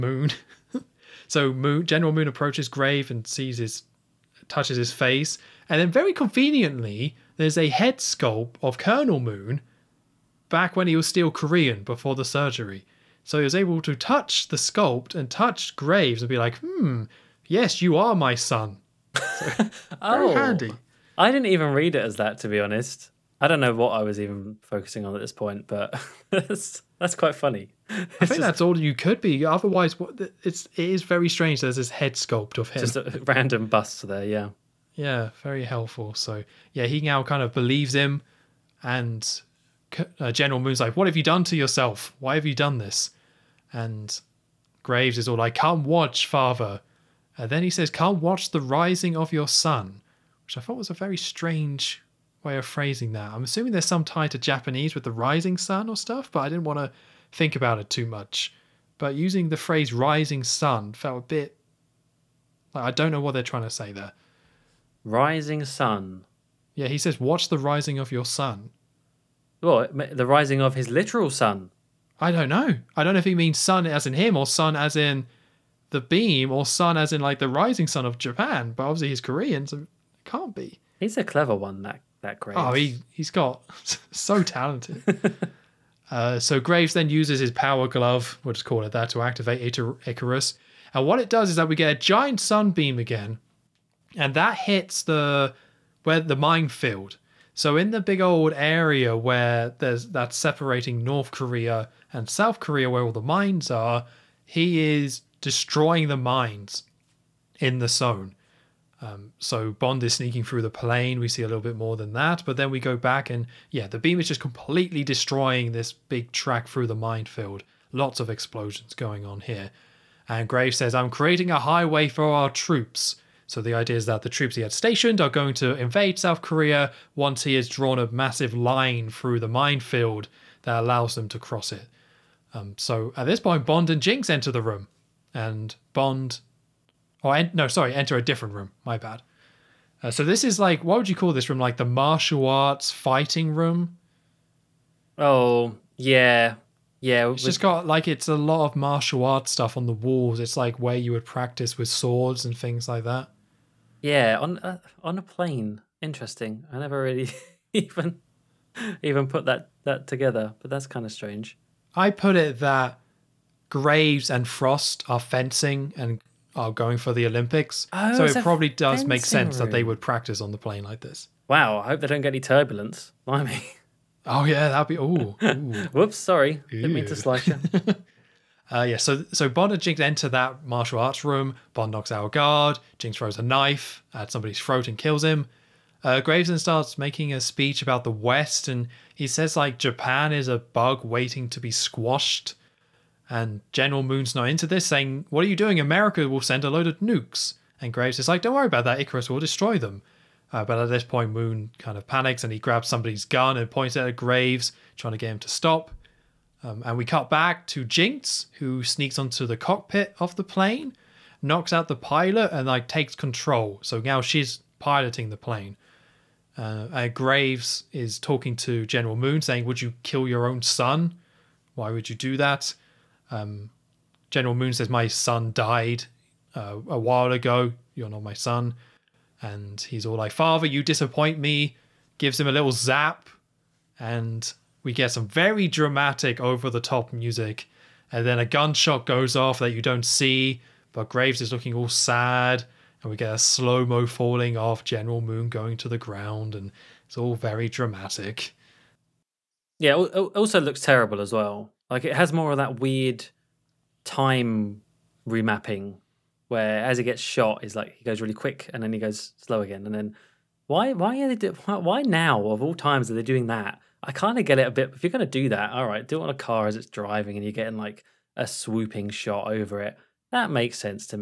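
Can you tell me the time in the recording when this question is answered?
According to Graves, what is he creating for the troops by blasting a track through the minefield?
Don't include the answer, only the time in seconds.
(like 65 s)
121 s.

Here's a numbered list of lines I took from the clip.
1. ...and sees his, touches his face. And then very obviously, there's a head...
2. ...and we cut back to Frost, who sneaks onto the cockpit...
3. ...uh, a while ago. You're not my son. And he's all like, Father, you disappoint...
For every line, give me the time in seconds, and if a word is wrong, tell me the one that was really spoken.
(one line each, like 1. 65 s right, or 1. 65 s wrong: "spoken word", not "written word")
1. 3 s wrong: "conveniently", not "obviously"
2. 206 s wrong: "Jinx", not "Frost"
3. 226 s right.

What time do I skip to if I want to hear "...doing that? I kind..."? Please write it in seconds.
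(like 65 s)
263 s.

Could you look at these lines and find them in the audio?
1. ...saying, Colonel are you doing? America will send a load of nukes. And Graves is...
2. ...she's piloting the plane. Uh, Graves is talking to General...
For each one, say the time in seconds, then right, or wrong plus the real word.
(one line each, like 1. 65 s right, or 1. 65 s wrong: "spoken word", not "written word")
1. 194 s wrong: "What", not "Colonel"
2. 214 s right.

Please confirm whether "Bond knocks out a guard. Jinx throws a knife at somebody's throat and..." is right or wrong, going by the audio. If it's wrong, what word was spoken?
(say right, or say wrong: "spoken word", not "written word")
right.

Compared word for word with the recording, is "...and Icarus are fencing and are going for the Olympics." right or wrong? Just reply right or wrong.
wrong.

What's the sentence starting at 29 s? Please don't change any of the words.
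Otherwise, it's it is very strange.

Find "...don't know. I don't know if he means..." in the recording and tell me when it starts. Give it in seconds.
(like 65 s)
72 s.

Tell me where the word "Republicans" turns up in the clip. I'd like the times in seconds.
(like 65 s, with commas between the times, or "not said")
not said.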